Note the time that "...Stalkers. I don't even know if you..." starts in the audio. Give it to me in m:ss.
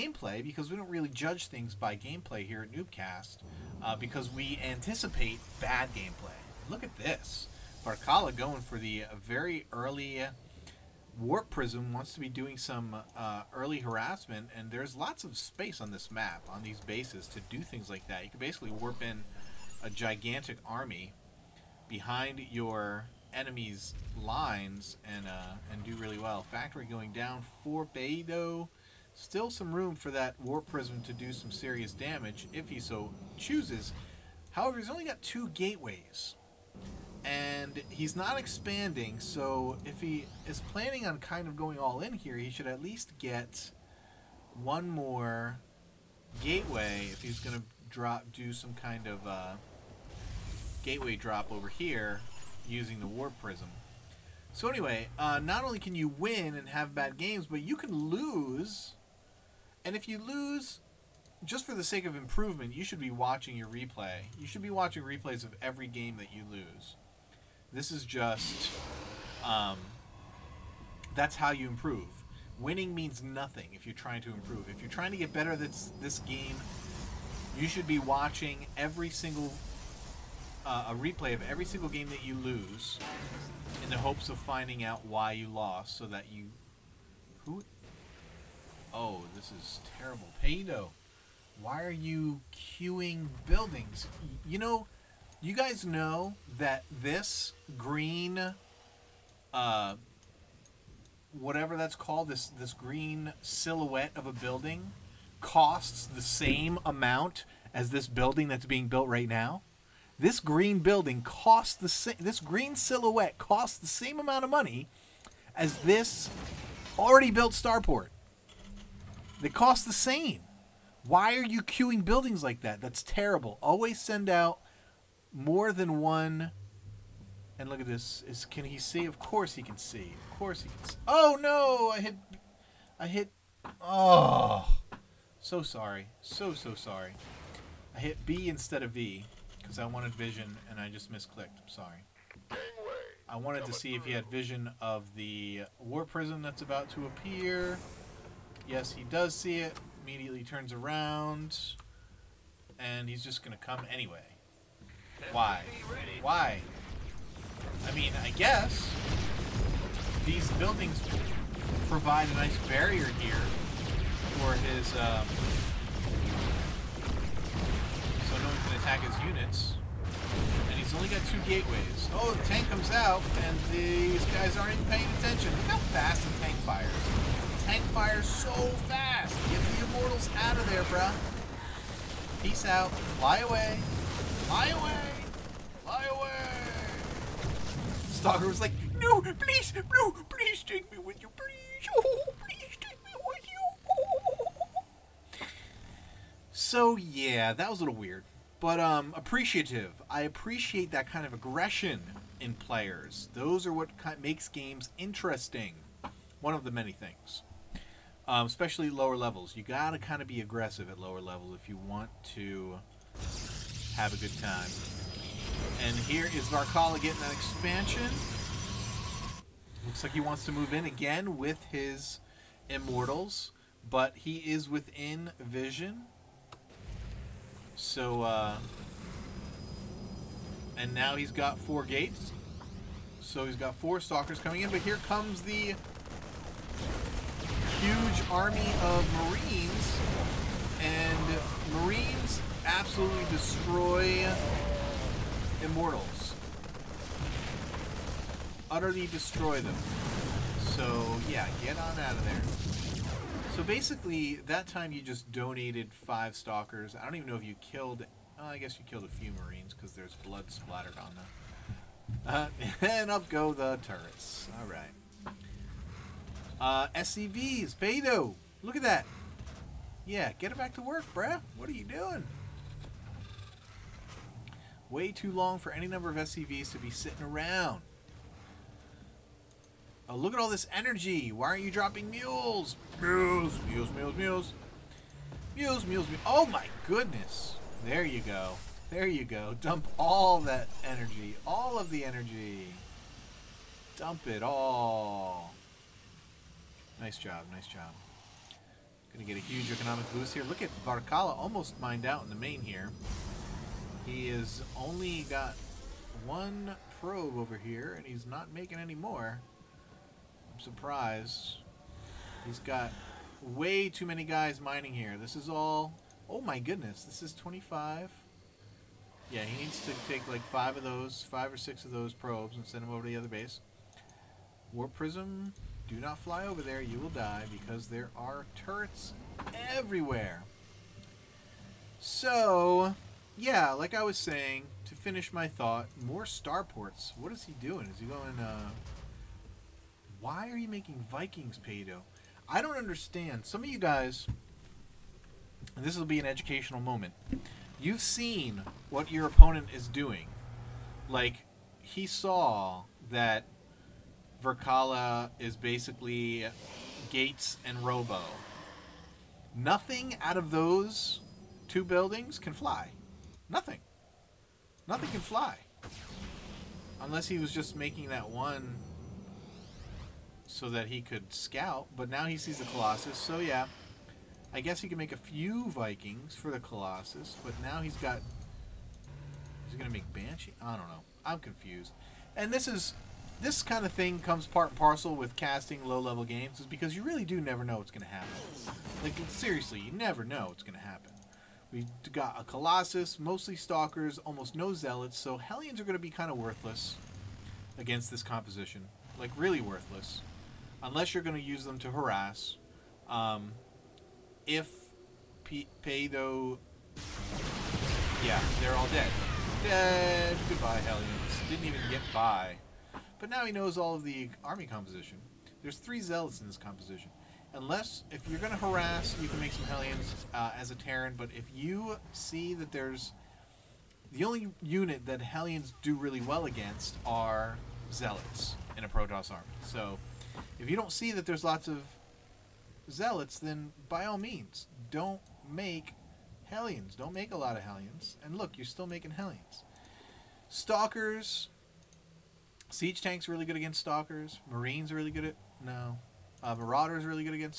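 4:16.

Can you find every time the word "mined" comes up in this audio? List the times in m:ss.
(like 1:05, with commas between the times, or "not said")
5:01.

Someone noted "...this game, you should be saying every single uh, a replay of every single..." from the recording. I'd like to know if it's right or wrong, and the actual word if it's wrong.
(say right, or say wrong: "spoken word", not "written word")
wrong: "watching", not "saying".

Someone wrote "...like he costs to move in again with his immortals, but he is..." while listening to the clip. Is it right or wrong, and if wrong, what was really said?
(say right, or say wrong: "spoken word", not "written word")
wrong: "wants", not "costs".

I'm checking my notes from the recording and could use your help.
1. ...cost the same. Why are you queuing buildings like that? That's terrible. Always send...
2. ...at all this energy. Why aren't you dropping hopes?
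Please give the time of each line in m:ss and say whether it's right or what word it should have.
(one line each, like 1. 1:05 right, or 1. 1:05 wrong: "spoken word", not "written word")
1. 1:59 right
2. 4:40 wrong: "mules", not "hopes".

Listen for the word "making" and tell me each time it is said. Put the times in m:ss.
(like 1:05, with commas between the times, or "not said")
5:08, 5:40, 6:07, 7:18.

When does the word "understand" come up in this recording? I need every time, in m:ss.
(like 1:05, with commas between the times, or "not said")
5:42.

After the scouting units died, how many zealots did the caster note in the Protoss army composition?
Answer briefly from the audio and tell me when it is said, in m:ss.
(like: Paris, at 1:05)
3, at 6:55.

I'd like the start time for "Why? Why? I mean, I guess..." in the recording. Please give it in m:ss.
2:35.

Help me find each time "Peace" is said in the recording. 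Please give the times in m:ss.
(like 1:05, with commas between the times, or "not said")
3:02.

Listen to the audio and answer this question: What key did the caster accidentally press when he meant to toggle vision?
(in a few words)
B.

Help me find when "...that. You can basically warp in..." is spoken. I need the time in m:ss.
0:18.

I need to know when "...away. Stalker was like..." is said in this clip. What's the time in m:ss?
3:06.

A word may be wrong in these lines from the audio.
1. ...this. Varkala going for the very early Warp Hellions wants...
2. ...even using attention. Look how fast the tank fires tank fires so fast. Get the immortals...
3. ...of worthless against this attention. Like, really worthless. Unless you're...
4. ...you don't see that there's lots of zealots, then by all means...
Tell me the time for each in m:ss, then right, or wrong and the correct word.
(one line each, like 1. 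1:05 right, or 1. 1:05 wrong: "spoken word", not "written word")
1. 0:06 wrong: "Prism", not "Hellions"
2. 2:54 wrong: "paying", not "using"
3. 6:36 wrong: "composition", not "attention"
4. 7:10 right.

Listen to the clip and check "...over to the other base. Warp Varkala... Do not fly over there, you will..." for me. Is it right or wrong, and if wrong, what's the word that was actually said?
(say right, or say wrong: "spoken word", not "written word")
wrong: "Prism", not "Varkala".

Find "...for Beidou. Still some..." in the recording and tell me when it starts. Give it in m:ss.
0:27.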